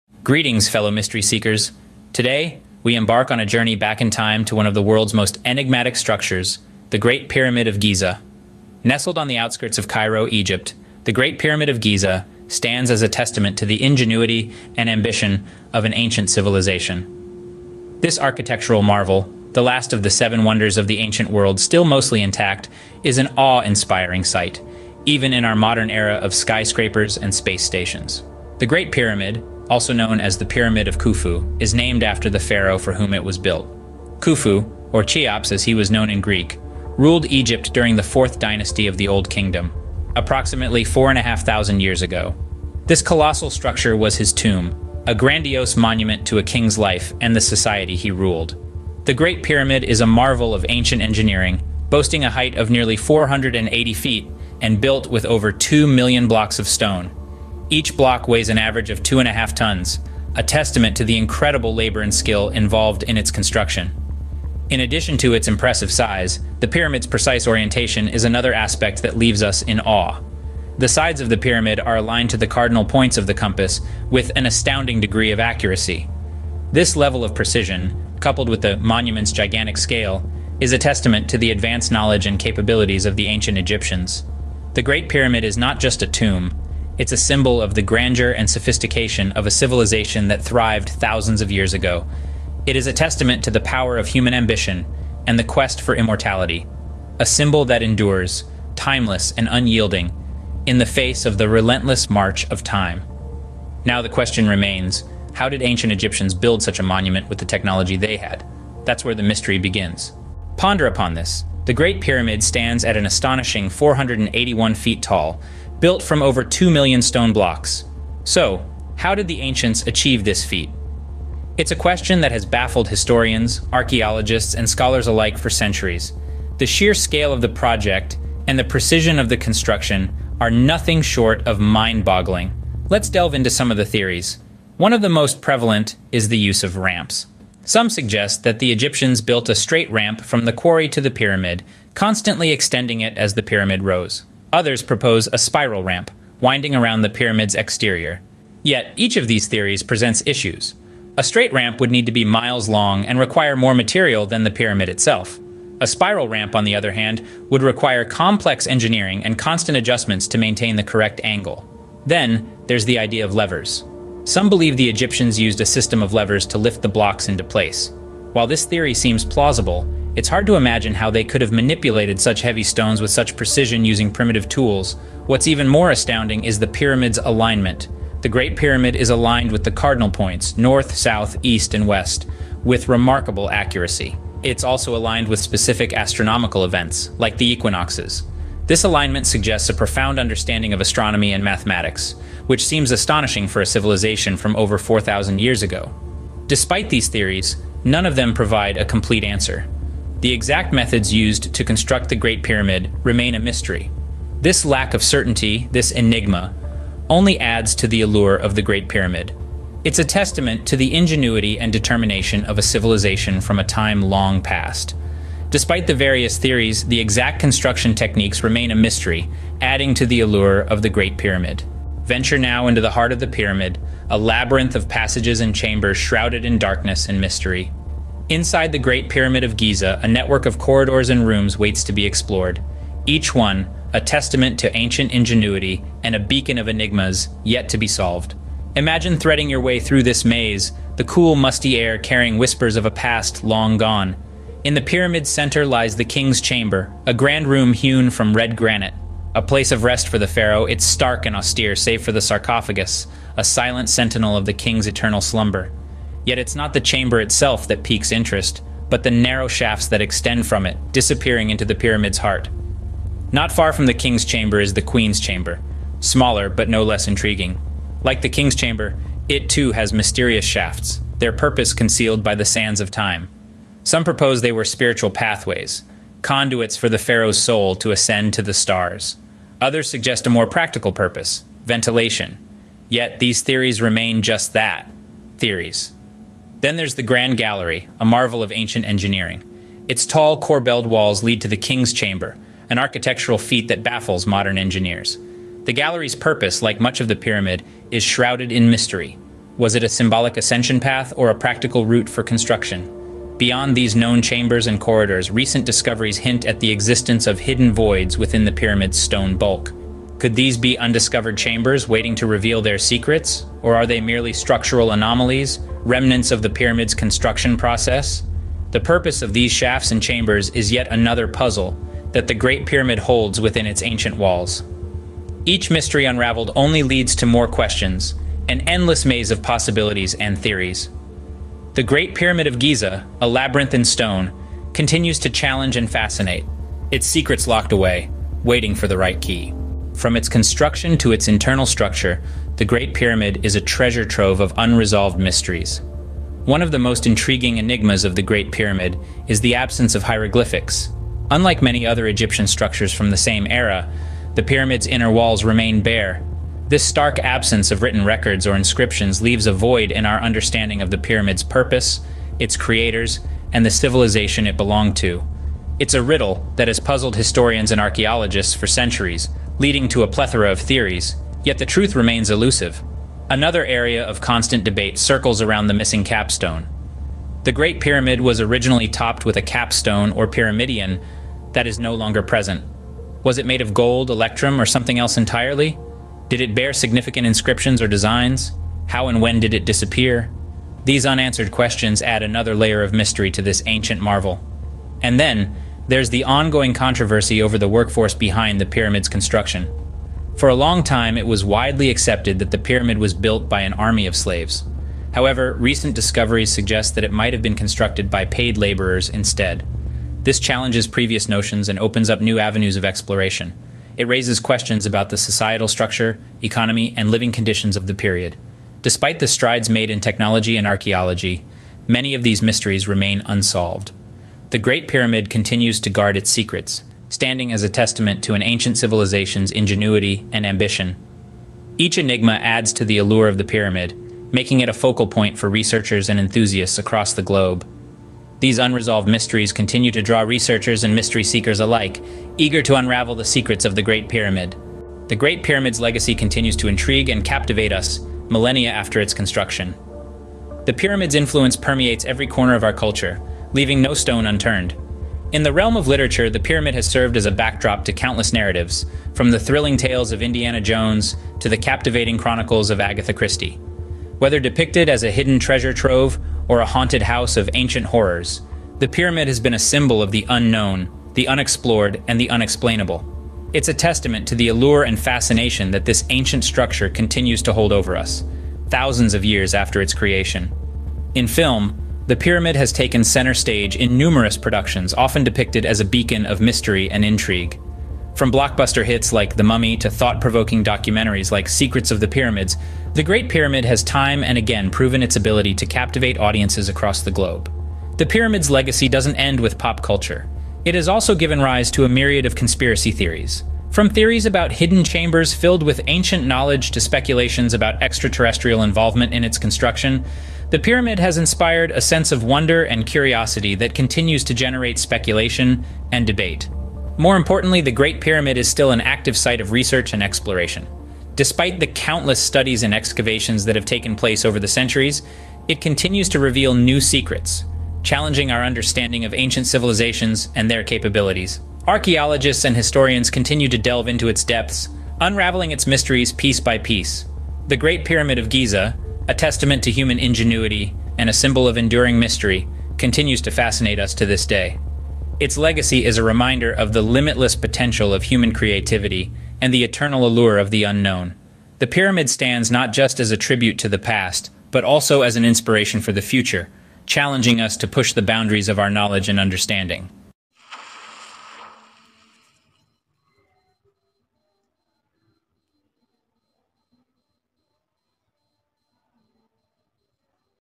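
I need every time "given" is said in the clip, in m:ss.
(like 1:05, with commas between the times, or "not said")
8:21.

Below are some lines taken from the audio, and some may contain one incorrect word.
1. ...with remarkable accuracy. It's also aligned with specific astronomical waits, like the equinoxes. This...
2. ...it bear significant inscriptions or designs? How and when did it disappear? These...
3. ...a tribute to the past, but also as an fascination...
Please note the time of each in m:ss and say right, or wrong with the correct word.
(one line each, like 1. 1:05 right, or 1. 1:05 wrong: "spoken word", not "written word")
1. 3:02 wrong: "events", not "waits"
2. 6:26 right
3. 9:13 wrong: "inspiration", not "fascination".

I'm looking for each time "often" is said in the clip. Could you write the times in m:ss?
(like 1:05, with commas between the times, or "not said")
8:04.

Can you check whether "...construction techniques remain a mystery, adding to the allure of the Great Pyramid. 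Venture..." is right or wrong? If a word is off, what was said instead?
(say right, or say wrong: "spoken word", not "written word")
right.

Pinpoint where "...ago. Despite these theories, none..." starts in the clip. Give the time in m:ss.
3:15.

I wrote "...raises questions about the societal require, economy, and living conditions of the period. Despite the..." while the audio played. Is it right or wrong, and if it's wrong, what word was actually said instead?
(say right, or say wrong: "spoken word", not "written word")
wrong: "structure", not "require".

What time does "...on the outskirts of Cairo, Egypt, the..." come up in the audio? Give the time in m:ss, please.
0:09.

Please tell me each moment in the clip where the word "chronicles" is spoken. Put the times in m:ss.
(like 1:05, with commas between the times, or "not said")
7:42.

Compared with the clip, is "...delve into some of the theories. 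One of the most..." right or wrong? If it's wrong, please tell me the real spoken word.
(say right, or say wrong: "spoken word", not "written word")
right.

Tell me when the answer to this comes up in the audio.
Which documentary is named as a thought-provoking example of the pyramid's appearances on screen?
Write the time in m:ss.
8:11.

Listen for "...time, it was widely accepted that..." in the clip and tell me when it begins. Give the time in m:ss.
6:40.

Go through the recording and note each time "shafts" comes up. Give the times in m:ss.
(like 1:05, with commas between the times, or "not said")
4:19, 4:30, 5:19.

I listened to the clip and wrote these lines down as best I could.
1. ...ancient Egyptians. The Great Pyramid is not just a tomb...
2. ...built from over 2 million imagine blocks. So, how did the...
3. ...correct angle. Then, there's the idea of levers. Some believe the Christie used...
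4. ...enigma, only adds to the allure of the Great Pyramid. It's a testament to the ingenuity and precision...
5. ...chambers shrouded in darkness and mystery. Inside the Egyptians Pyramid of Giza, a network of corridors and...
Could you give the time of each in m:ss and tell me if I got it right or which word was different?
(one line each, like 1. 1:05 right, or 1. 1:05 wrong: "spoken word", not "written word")
1. 1:23 right
2. 1:55 wrong: "stone", not "imagine"
3. 2:40 wrong: "Egyptians", not "Christie"
4. 3:25 wrong: "determination", not "precision"
5. 3:45 wrong: "Great", not "Egyptians".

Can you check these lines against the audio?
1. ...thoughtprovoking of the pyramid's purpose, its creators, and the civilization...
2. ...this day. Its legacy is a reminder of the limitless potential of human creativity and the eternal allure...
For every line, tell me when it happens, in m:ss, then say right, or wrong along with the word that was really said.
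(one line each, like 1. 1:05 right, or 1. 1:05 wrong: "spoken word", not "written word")
1. 6:00 wrong: "understanding", not "thoughtprovoking"
2. 9:04 right.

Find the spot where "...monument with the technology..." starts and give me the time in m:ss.
1:46.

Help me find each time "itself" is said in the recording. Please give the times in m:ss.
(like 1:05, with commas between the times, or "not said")
2:34, 4:17.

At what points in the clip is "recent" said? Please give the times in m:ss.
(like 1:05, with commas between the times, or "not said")
5:05, 6:45.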